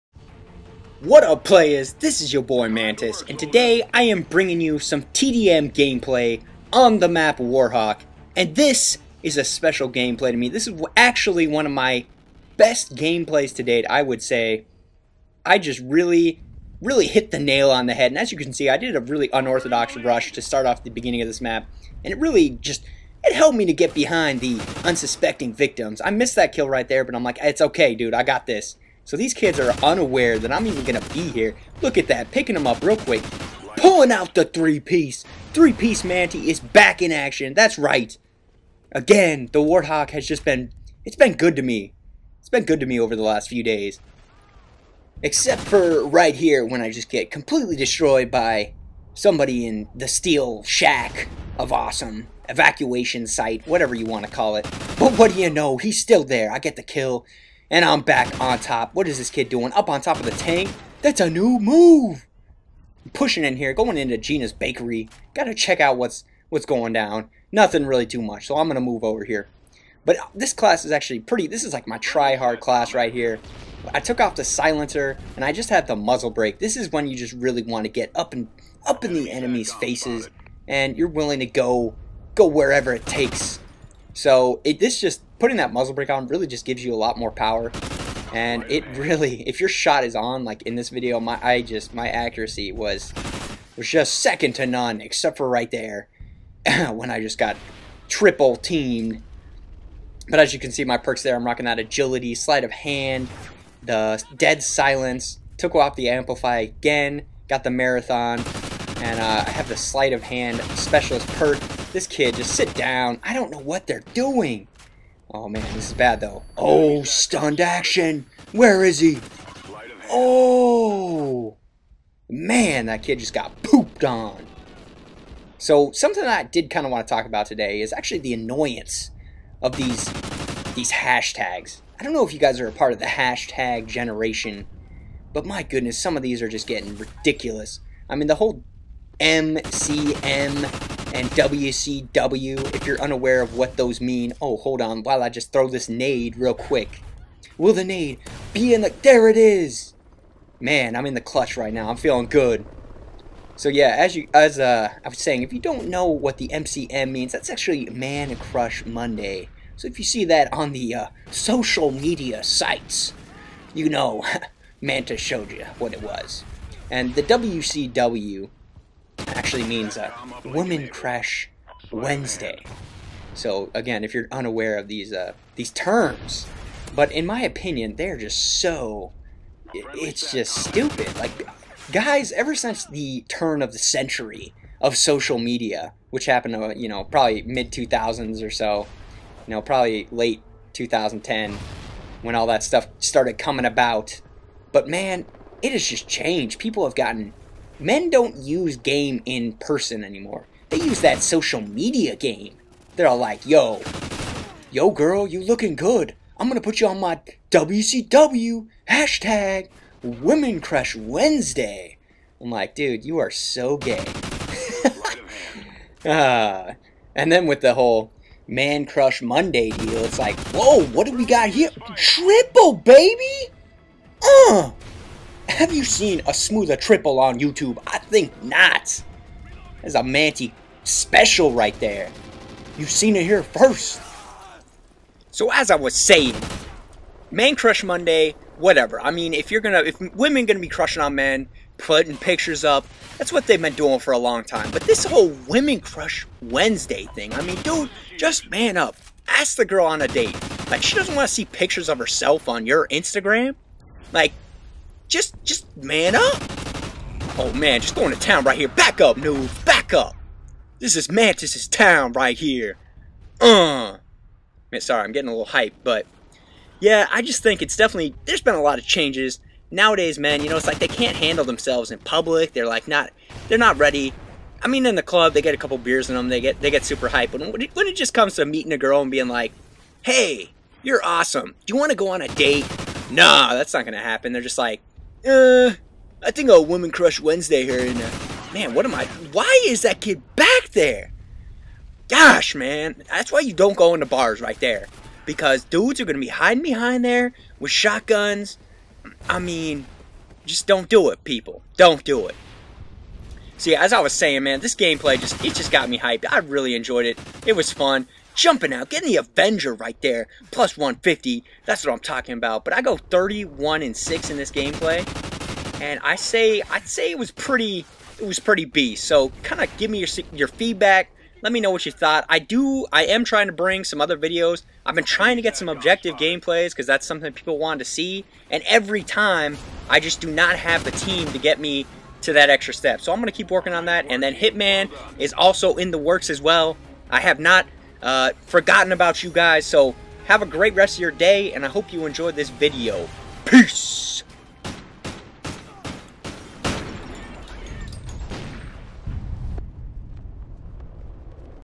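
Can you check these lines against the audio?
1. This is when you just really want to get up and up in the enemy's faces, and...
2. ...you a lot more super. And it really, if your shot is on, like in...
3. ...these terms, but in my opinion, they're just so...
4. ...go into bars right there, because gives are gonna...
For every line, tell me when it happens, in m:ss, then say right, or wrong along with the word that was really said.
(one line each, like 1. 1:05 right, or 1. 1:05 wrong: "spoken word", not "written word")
1. 1:16 right
2. 1:26 wrong: "power", not "super"
3. 2:55 right
4. 4:53 wrong: "dudes", not "gives".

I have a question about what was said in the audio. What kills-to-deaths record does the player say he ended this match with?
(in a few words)
31 and 6.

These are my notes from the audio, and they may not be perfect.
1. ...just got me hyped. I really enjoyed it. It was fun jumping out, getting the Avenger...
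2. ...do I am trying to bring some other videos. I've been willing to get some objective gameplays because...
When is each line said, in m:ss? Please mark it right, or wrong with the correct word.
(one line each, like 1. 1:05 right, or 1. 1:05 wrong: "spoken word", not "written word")
1. 5:05 right
2. 5:22 wrong: "trying", not "willing".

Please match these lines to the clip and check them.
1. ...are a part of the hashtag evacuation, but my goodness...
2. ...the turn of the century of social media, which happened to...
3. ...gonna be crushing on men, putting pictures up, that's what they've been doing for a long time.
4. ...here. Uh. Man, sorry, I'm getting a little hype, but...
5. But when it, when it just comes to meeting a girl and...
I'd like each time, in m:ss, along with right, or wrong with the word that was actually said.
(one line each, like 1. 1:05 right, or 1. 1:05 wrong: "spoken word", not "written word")
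1. 2:12 wrong: "generation", not "evacuation"
2. 3:02 right
3. 4:00 right
4. 4:22 right
5. 4:37 right.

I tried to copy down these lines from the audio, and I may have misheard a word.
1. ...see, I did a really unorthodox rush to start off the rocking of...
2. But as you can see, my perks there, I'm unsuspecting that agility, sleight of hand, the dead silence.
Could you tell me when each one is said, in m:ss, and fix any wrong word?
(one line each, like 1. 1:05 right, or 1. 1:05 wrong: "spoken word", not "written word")
1. 0:18 wrong: "beginning", not "rocking"
2. 1:40 wrong: "rocking", not "unsuspecting".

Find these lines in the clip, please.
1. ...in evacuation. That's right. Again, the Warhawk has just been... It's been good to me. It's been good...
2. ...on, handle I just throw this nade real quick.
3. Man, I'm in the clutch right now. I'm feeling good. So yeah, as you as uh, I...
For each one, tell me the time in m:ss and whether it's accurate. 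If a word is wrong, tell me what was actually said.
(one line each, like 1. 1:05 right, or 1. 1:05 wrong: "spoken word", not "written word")
1. 0:37 wrong: "action", not "evacuation"
2. 2:24 wrong: "while", not "handle"
3. 2:30 right.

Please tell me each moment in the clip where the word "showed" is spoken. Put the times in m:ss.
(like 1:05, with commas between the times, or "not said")
2:45.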